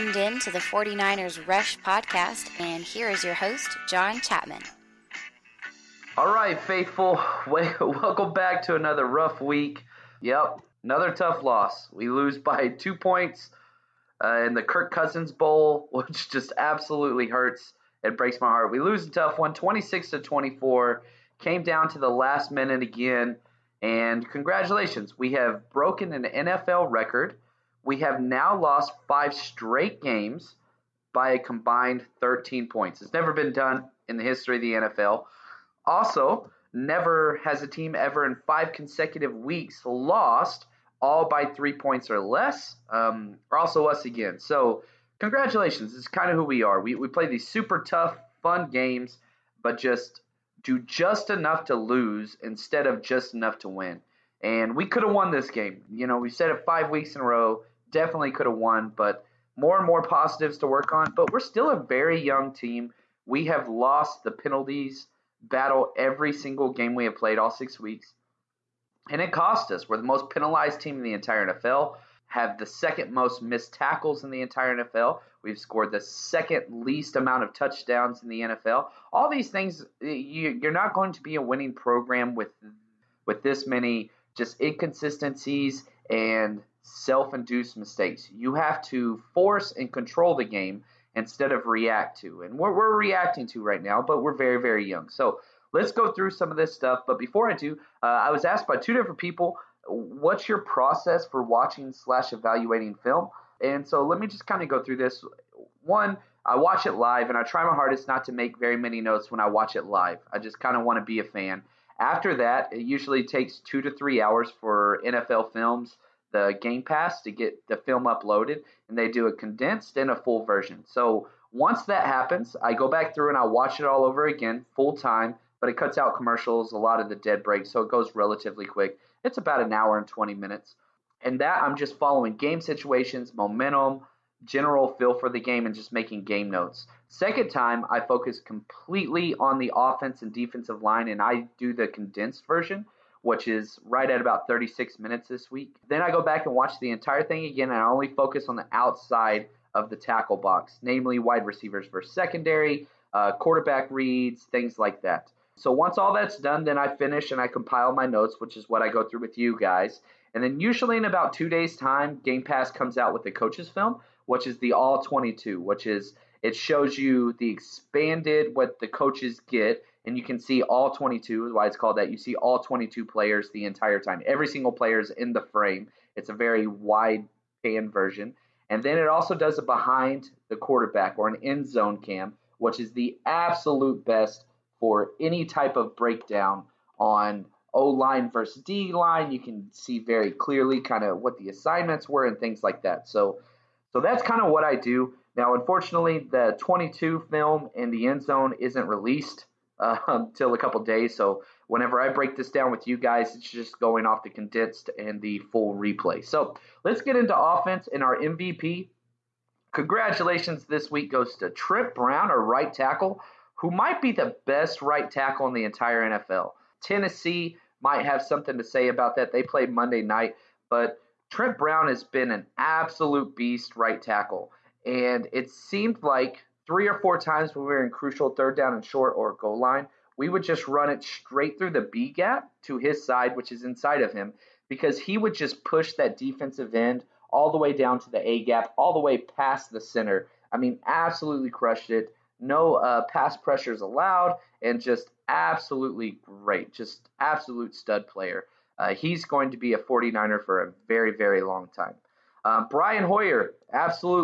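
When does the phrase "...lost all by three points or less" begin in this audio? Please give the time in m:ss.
0:39.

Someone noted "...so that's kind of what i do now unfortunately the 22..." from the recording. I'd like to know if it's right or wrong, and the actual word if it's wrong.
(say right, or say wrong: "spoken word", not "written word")
right.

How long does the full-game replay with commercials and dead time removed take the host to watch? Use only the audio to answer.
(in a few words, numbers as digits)
1 hour 20 minutes.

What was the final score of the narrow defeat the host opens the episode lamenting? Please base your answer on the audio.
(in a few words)
26 to 24.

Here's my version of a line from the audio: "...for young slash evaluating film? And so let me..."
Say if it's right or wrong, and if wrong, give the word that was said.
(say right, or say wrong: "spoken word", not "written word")
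wrong: "watching", not "young".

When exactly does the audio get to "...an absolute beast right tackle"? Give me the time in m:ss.
3:42.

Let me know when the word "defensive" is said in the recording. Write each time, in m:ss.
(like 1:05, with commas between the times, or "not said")
2:20, 3:56.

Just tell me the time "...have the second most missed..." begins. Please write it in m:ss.
1:12.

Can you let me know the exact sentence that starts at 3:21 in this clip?
So whenever I break this down with you guys, it's just going off the condensed and the full replay.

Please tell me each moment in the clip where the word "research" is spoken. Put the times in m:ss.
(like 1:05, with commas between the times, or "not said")
not said.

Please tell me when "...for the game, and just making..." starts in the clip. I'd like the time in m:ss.
2:15.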